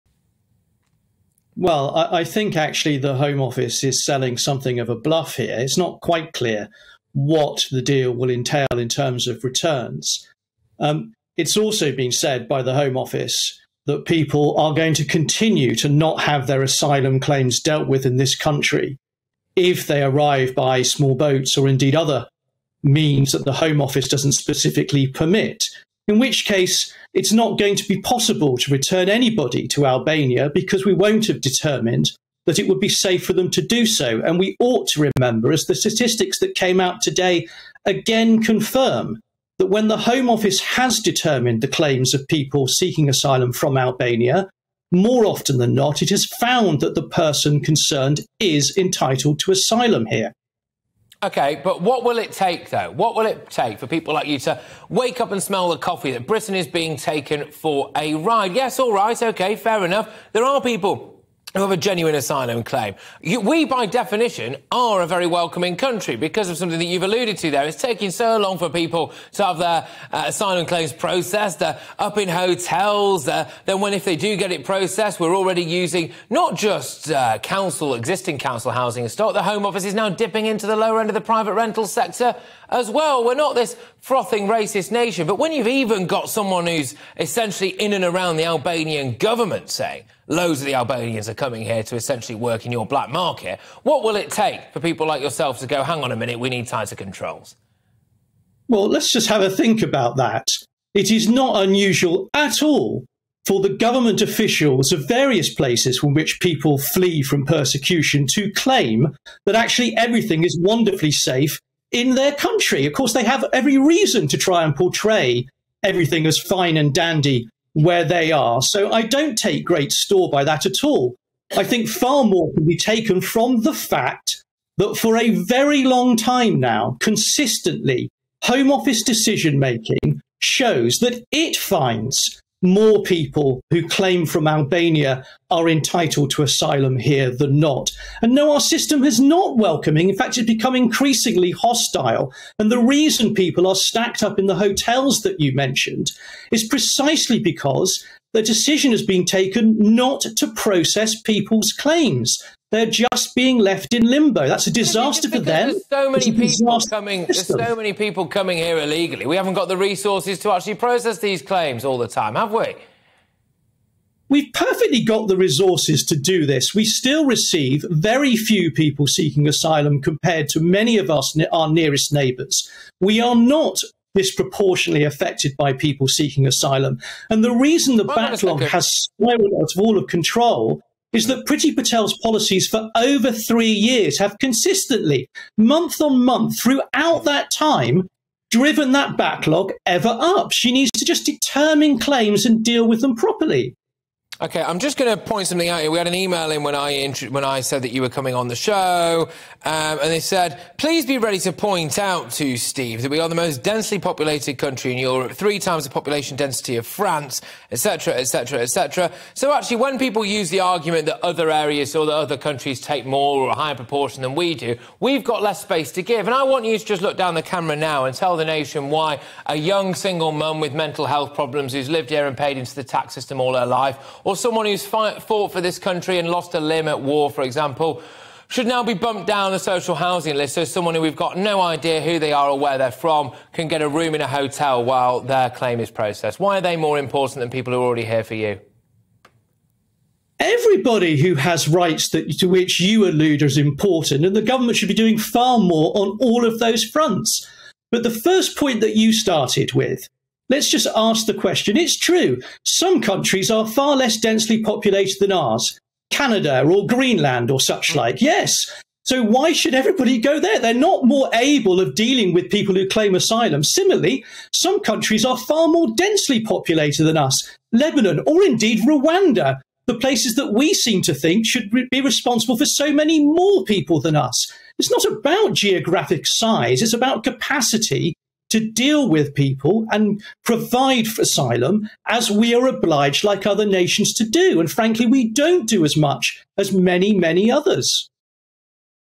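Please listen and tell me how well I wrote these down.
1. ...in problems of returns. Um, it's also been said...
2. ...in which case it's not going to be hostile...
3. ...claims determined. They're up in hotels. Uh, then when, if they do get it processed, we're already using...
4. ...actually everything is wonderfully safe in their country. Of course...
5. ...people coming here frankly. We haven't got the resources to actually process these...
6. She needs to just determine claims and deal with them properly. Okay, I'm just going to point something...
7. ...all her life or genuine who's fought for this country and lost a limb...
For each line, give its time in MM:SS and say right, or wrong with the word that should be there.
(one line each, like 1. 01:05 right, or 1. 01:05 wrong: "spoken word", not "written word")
1. 00:08 wrong: "terms", not "problems"
2. 00:26 wrong: "possible", not "hostile"
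3. 01:10 wrong: "processed", not "determined"
4. 01:49 right
5. 02:37 wrong: "illegally", not "frankly"
6. 03:10 right
7. 03:43 wrong: "someone", not "genuine".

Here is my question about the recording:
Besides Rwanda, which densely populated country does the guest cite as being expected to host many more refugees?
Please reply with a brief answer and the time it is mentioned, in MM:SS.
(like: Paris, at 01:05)
Lebanon, at 04:27.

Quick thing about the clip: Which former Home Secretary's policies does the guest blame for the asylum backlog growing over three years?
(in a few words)
Priti Patel.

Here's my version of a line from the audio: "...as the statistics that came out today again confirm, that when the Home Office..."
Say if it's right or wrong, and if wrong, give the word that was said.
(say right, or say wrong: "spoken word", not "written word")
right.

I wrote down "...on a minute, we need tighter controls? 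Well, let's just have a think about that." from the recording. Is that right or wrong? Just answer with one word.
right.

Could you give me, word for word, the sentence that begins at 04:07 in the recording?
But the first point that you started with Let's just ask the question.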